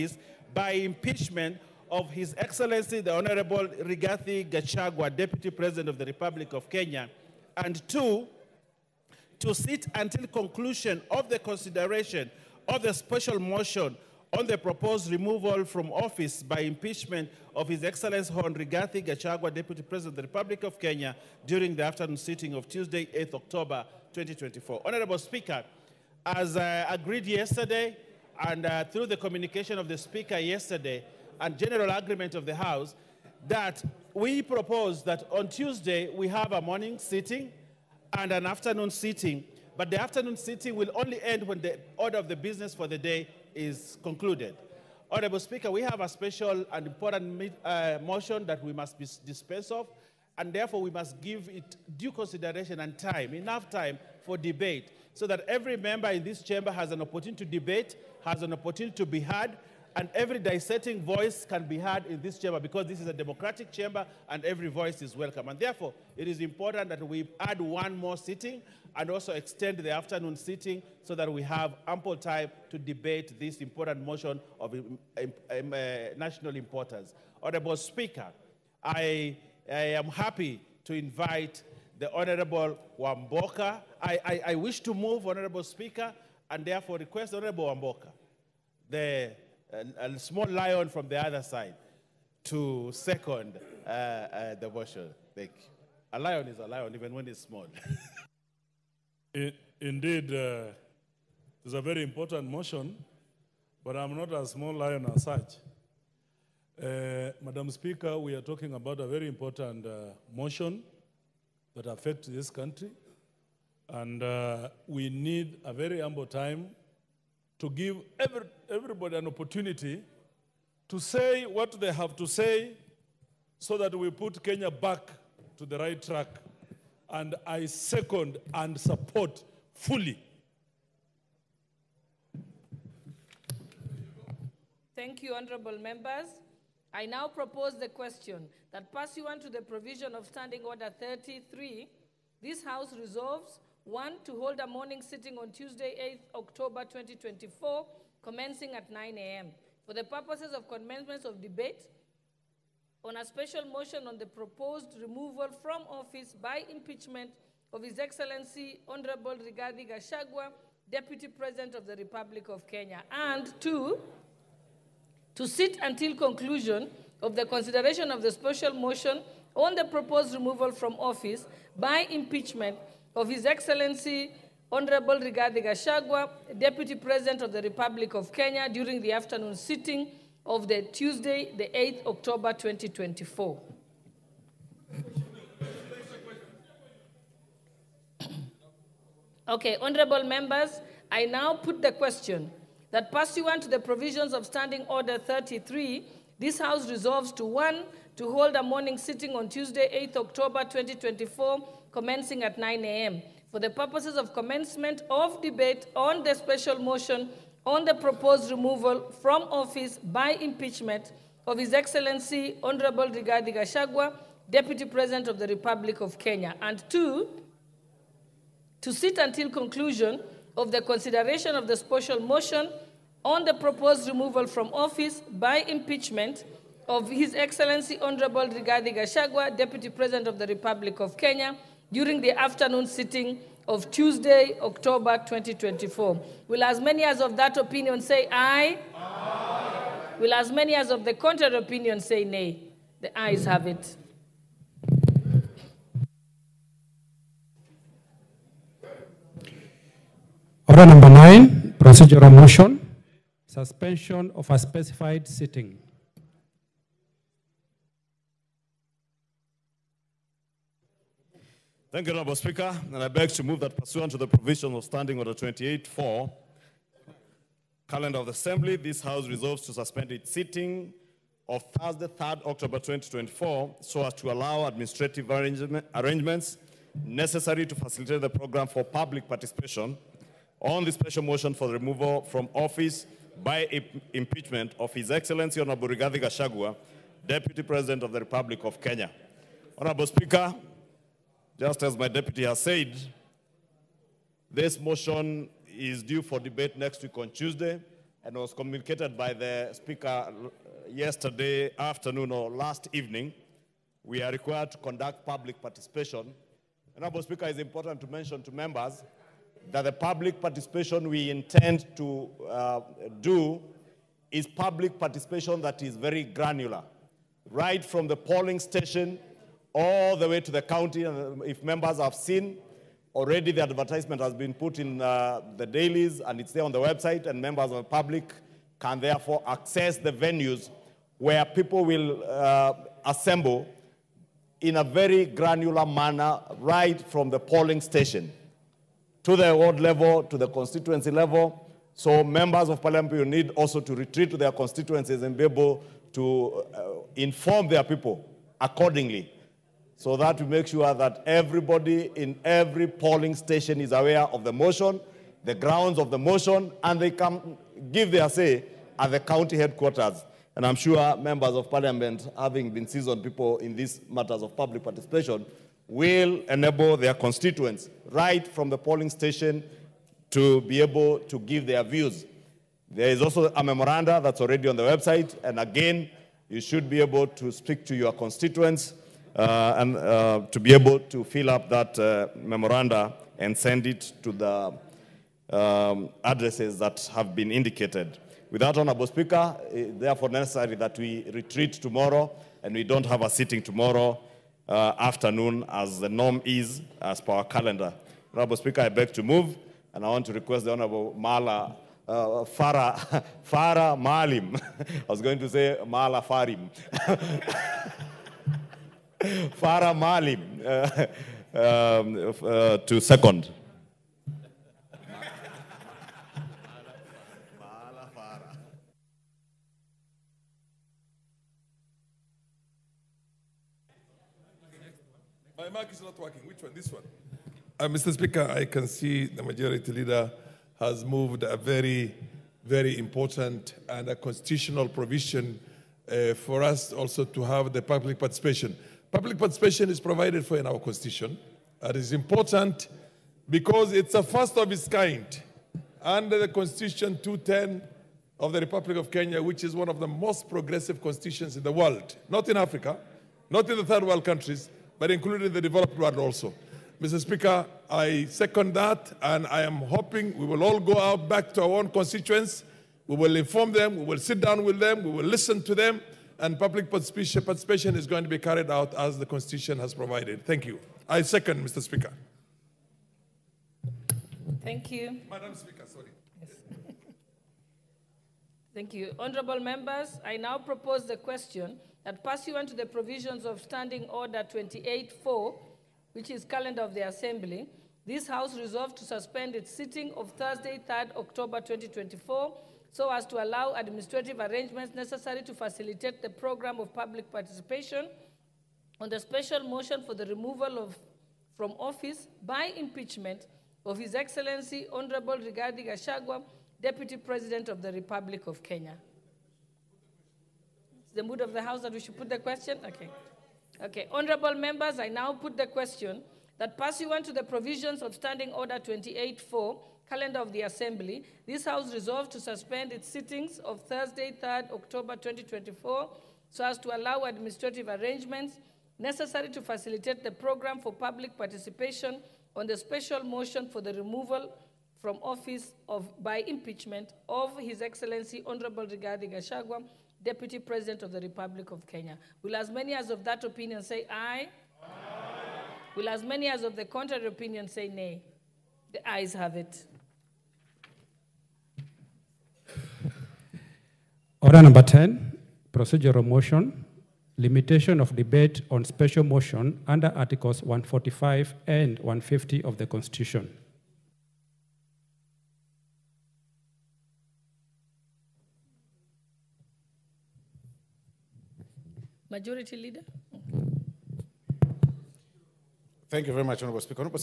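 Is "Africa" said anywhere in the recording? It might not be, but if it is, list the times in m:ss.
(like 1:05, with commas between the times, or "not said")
7:32.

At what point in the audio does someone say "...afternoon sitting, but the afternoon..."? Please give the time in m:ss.
0:38.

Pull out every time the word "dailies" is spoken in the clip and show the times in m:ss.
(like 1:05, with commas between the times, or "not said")
5:25.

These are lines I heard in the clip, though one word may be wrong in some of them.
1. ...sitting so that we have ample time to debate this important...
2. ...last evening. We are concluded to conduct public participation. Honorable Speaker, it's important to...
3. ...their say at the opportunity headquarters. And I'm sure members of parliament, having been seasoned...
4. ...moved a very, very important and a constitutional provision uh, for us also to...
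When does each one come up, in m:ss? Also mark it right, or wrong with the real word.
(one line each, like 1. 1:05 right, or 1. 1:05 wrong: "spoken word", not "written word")
1. 1:10 right
2. 5:02 wrong: "required", not "concluded"
3. 5:58 wrong: "county", not "opportunity"
4. 7:11 right.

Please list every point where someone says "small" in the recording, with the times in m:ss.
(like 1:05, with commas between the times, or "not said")
1:30, 1:37, 1:44.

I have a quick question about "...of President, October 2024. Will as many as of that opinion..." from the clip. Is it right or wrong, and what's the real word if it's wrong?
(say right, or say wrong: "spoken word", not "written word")
wrong: "Tuesday", not "President".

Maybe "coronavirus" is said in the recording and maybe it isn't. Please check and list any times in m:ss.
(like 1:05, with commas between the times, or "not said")
not said.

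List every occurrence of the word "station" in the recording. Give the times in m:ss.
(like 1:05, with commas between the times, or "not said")
5:18, 5:37, 5:53, 6:09.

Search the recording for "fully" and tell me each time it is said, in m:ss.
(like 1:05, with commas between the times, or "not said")
2:09.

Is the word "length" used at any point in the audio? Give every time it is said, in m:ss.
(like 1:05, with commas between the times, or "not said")
not said.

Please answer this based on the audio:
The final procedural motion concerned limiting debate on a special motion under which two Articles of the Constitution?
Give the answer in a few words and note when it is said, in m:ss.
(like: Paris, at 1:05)
Articles 145 and 150, at 9:20.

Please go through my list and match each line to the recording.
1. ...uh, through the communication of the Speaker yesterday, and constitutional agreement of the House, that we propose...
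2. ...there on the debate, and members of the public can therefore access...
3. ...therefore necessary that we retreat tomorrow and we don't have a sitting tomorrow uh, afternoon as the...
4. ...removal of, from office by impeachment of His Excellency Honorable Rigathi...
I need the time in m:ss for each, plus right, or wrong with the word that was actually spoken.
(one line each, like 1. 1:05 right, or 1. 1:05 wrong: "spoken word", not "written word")
1. 0:28 wrong: "general", not "constitutional"
2. 5:26 wrong: "website", not "debate"
3. 6:29 right
4. 8:20 right.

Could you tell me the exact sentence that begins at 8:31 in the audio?
It's the mood of the House that we should put the question?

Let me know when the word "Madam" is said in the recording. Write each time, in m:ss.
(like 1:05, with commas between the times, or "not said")
1:47, 7:55.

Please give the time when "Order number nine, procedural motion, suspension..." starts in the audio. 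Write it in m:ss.
4:10.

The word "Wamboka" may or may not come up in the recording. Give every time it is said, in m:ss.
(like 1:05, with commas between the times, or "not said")
1:22, 1:27.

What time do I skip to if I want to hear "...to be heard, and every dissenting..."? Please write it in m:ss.
0:58.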